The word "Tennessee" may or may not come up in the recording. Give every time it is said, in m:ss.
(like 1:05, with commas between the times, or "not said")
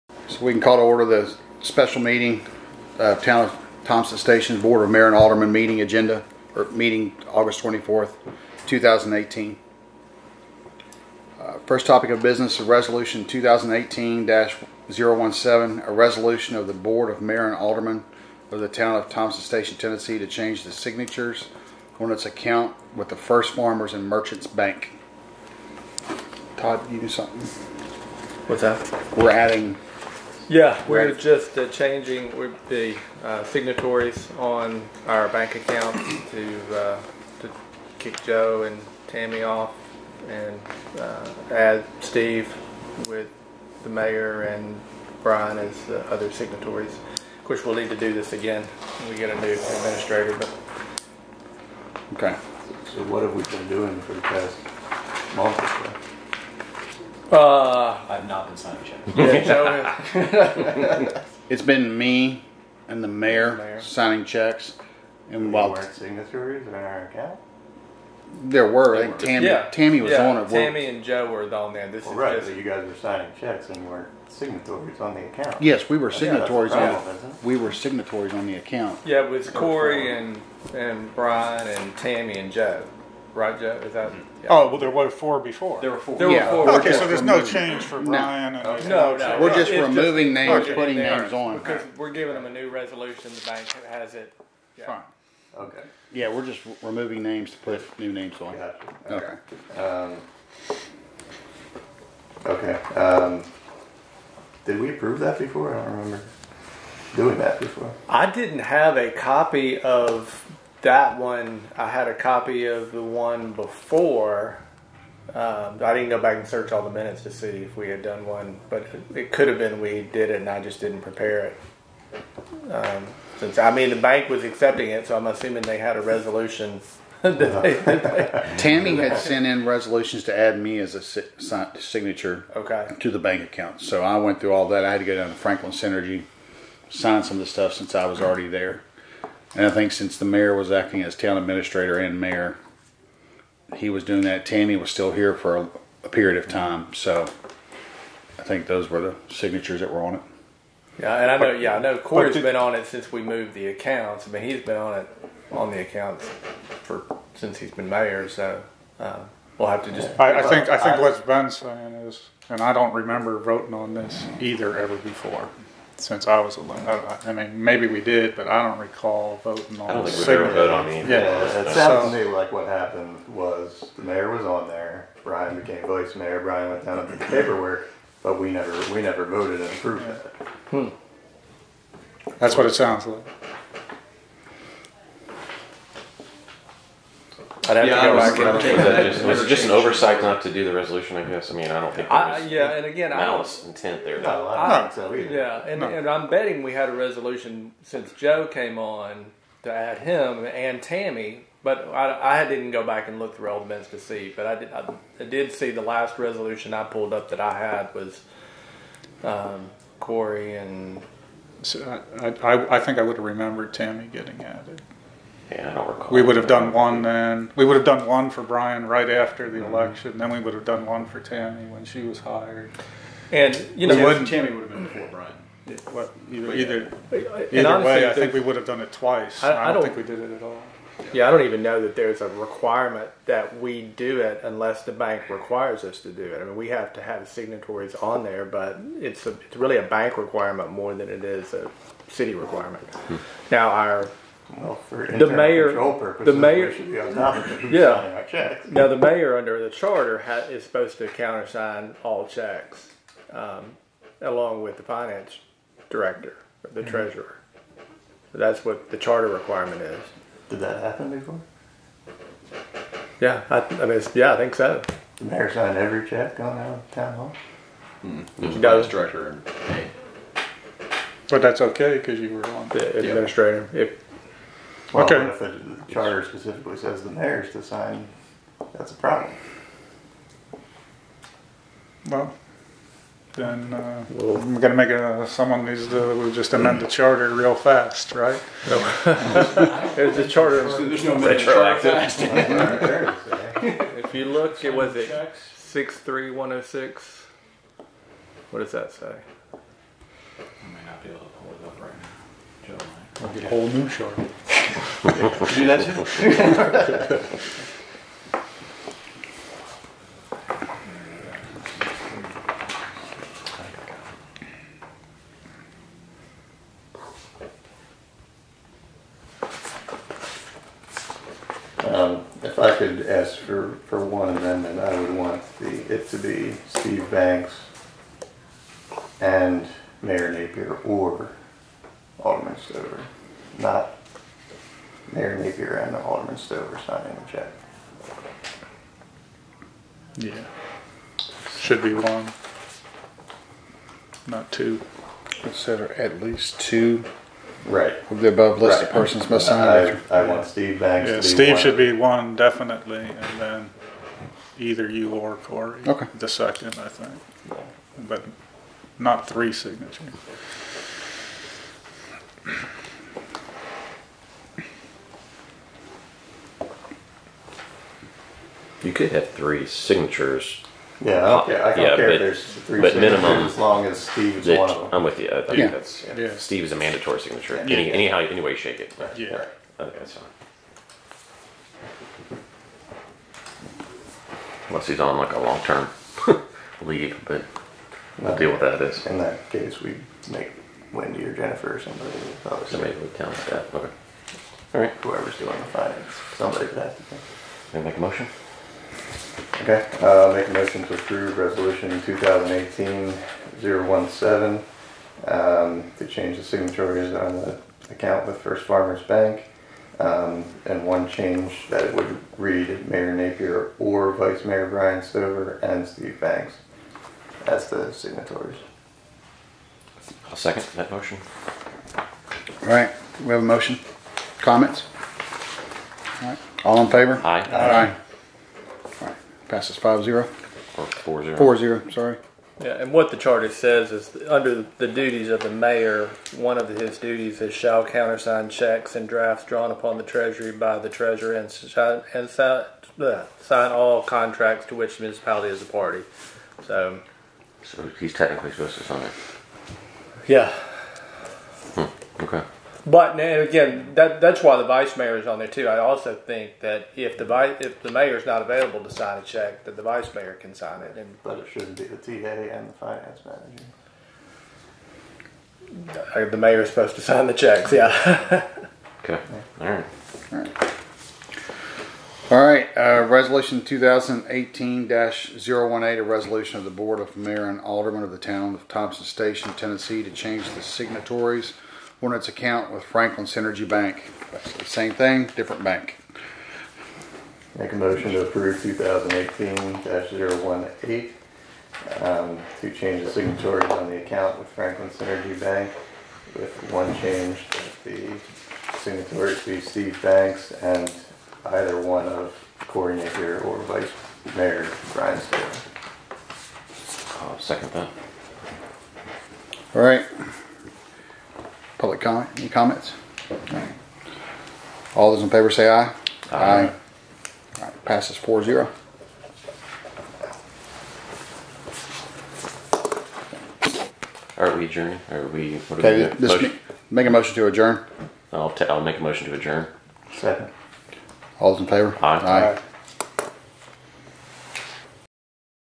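0:19, 7:59.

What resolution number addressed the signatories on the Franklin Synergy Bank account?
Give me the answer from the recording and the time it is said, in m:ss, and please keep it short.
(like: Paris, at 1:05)
2018-018, at 7:53.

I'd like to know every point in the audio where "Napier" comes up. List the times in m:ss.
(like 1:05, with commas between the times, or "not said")
5:30, 5:35, 6:53, 8:22.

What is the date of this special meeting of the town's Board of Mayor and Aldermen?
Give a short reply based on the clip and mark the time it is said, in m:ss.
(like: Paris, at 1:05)
August 24th, 2018, at 0:07.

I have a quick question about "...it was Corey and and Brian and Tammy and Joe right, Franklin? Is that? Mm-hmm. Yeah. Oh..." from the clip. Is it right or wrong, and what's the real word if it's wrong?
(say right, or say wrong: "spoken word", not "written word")
wrong: "Joe", not "Franklin".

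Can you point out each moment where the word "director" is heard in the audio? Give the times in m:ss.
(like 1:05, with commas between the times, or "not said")
4:15, 4:28.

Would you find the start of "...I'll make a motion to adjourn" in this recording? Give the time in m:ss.
8:48.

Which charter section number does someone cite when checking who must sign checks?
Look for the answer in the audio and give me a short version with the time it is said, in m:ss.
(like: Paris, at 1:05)
6-3-106, at 4:55.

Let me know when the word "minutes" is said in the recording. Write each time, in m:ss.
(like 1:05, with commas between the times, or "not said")
1:56, 3:23.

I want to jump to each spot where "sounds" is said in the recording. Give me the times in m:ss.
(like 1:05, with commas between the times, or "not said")
2:51, 3:02.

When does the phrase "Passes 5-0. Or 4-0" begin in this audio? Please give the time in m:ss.
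7:09.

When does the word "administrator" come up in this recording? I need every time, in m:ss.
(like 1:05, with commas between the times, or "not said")
0:49, 2:21, 4:32.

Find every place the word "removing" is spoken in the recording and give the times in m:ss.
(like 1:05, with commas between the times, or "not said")
1:29, 1:36.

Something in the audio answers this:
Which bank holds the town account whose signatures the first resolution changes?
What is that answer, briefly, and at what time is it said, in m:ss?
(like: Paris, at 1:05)
First Farmers and Merchants Bank, at 0:23.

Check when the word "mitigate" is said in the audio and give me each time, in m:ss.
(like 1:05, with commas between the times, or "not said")
not said.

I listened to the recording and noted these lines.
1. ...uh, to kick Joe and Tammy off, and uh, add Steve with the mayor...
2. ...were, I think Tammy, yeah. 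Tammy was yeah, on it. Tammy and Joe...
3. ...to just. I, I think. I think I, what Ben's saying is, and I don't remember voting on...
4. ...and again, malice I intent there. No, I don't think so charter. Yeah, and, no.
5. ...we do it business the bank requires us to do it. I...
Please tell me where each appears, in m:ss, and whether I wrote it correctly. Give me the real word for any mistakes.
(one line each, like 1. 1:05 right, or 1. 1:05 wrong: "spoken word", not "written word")
1. 0:36 right
2. 1:08 right
3. 2:39 right
4. 3:12 wrong: "either", not "charter"
5. 3:53 wrong: "unless", not "business".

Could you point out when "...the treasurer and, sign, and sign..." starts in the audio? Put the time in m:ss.
7:20.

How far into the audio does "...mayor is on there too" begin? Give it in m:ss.
7:34.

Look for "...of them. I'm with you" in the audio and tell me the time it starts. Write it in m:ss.
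6:14.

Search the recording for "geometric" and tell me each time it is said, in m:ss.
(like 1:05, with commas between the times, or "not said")
not said.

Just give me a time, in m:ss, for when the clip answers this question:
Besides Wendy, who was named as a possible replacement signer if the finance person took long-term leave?
6:31.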